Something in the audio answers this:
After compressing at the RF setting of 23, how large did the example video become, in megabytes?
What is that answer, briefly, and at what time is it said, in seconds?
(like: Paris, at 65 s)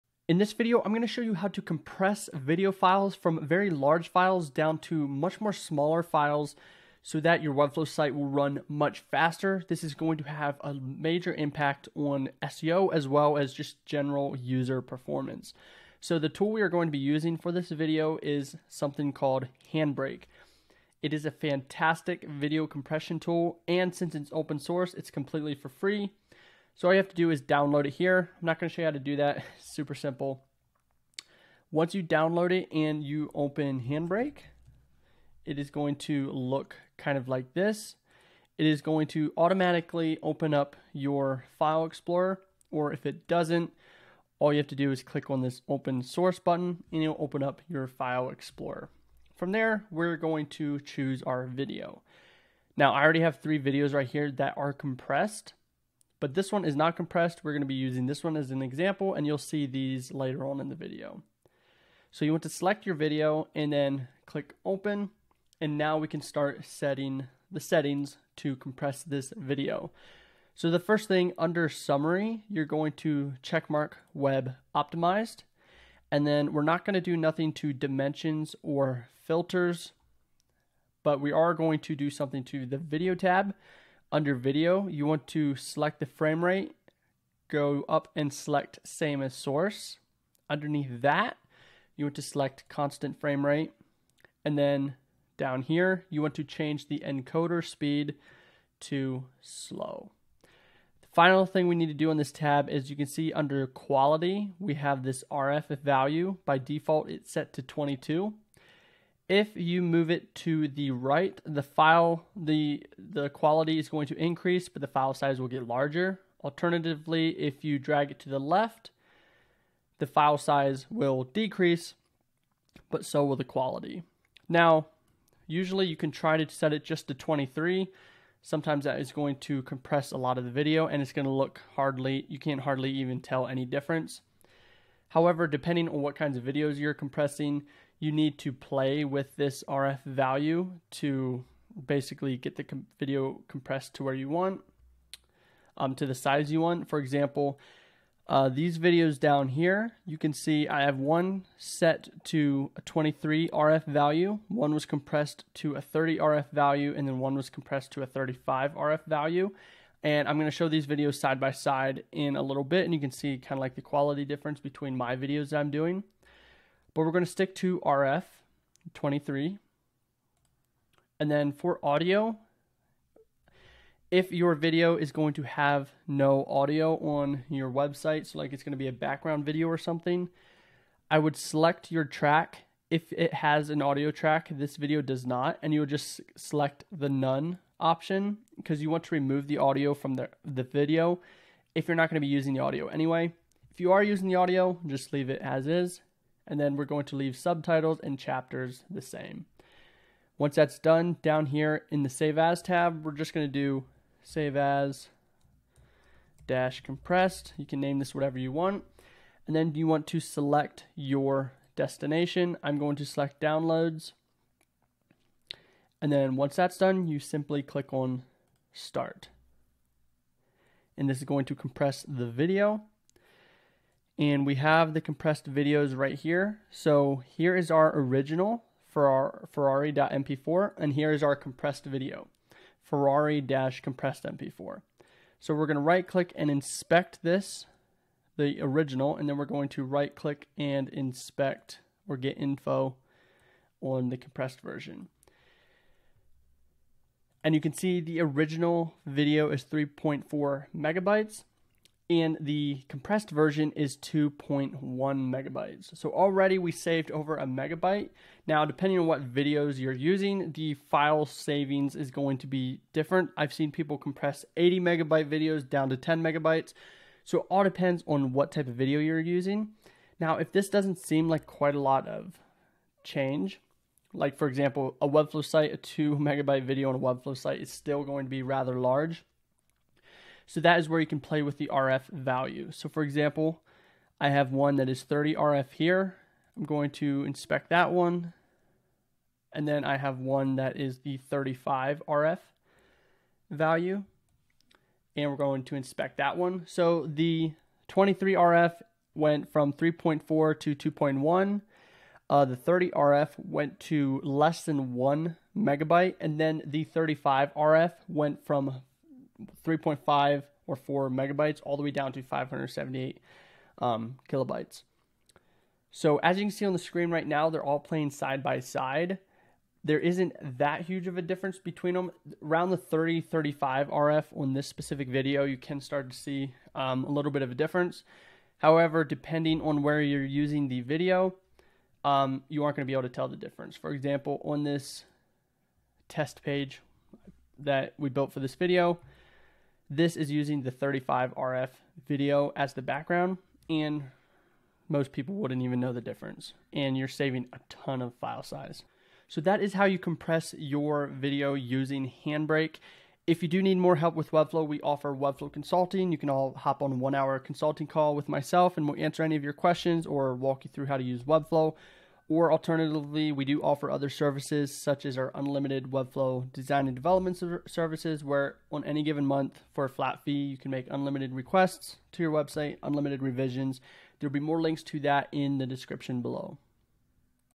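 2.1 megabytes, at 253 s.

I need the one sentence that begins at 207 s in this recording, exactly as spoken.
You can name this whatever you want.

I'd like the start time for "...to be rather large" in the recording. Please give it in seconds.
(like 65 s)
278 s.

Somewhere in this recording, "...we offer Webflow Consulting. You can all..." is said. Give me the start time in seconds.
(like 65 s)
354 s.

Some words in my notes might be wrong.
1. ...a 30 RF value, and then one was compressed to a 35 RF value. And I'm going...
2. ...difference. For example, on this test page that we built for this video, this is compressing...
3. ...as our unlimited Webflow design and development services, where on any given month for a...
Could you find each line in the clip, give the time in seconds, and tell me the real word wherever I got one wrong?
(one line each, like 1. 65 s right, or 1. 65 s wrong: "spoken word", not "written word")
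1. 155 s right
2. 333 s wrong: "using", not "compressing"
3. 365 s right.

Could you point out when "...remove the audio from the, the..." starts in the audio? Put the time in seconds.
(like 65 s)
189 s.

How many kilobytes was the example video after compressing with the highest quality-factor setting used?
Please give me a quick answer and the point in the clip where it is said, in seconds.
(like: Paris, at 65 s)
578 kilobytes, at 312 s.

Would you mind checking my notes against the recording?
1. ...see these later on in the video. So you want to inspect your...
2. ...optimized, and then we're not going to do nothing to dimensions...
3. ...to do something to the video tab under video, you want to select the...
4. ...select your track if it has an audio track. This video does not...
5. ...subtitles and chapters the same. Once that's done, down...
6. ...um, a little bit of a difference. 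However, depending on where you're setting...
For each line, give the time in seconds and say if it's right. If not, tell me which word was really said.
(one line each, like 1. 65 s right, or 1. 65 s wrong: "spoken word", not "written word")
1. 59 s wrong: "select", not "inspect"
2. 74 s right
3. 81 s right
4. 181 s right
5. 197 s right
6. 326 s wrong: "using", not "setting".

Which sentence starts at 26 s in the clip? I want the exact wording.
So all you have to do is download it here.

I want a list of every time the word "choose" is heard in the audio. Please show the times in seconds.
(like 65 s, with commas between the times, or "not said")
50 s.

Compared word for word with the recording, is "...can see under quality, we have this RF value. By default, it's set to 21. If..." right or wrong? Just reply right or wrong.
wrong.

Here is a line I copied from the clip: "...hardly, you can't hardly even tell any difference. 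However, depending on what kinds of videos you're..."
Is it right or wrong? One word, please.
right.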